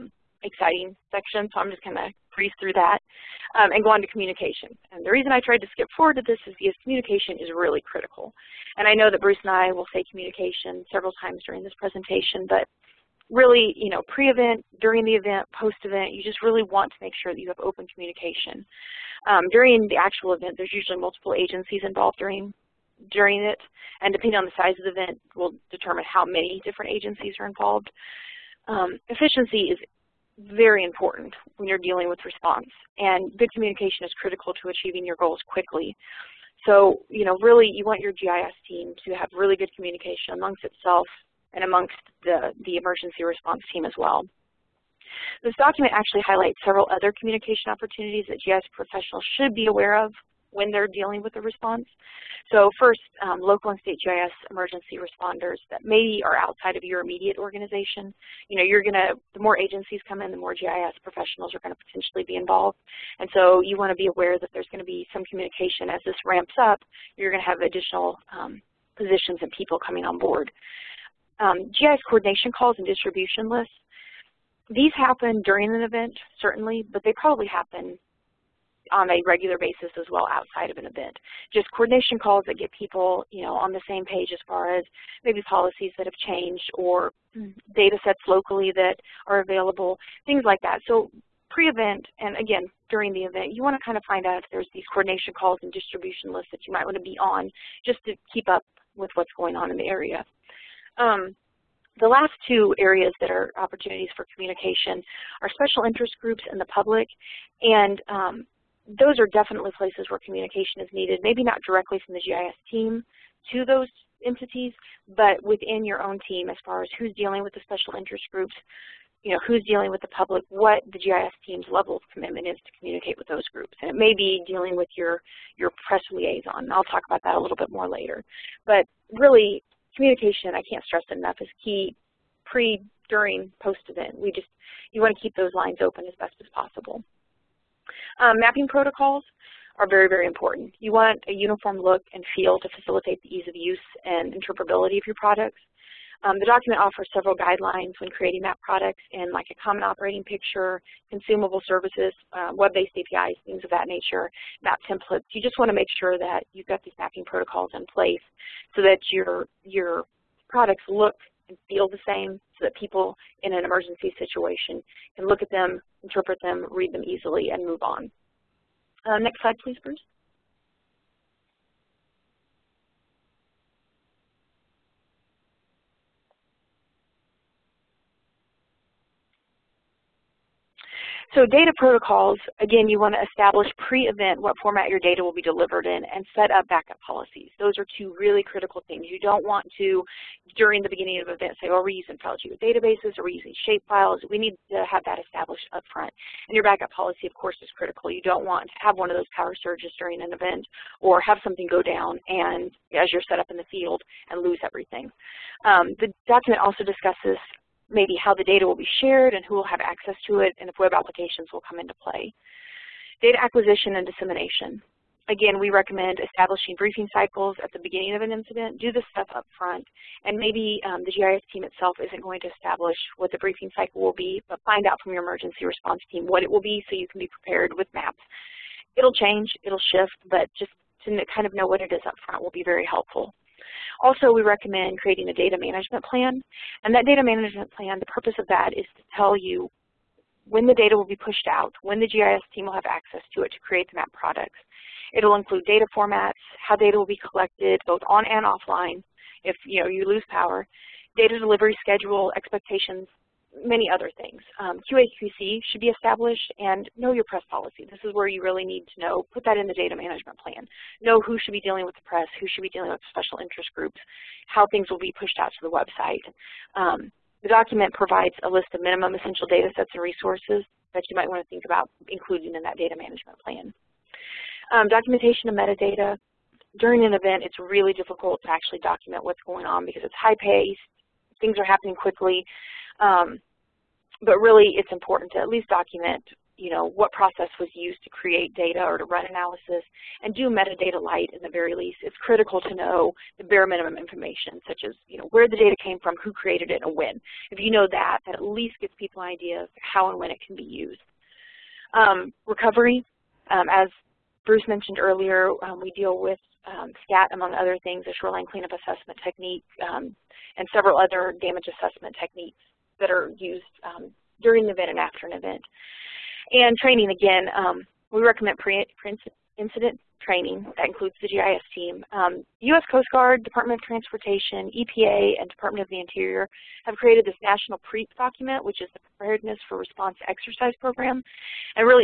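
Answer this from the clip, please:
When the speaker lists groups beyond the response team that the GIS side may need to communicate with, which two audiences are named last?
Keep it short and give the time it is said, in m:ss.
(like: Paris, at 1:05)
Special interest groups and the public, at 1:45.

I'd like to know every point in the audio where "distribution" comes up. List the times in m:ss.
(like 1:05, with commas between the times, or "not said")
1:12, 1:35.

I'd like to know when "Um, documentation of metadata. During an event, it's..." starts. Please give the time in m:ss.
4:34.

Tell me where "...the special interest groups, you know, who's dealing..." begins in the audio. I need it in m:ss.
1:57.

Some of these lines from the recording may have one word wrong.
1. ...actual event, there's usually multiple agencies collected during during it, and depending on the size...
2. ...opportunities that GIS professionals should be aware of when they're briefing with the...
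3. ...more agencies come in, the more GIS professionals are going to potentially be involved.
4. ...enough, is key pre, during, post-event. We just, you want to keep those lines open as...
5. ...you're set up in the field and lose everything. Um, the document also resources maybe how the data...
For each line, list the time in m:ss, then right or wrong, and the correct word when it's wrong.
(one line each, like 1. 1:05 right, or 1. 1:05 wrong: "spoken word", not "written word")
1. 0:19 wrong: "involved", not "collected"
2. 0:47 wrong: "dealing", not "briefing"
3. 0:59 right
4. 2:11 right
5. 3:23 wrong: "discusses", not "resources".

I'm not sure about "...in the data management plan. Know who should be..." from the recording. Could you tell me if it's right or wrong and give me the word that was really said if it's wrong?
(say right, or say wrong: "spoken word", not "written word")
right.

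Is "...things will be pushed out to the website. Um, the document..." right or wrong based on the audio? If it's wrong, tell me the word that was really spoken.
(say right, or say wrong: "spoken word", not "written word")
right.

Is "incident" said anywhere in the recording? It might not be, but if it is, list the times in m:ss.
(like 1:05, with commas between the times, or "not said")
3:38, 5:18.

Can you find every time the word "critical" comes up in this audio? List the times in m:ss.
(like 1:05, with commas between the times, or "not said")
0:07, 0:34, 3:08, 3:17, 4:52.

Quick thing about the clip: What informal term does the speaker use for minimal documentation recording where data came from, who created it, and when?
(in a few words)
Metadata light.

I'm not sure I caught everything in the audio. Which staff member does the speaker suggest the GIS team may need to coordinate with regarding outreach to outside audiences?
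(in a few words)
Press liaison.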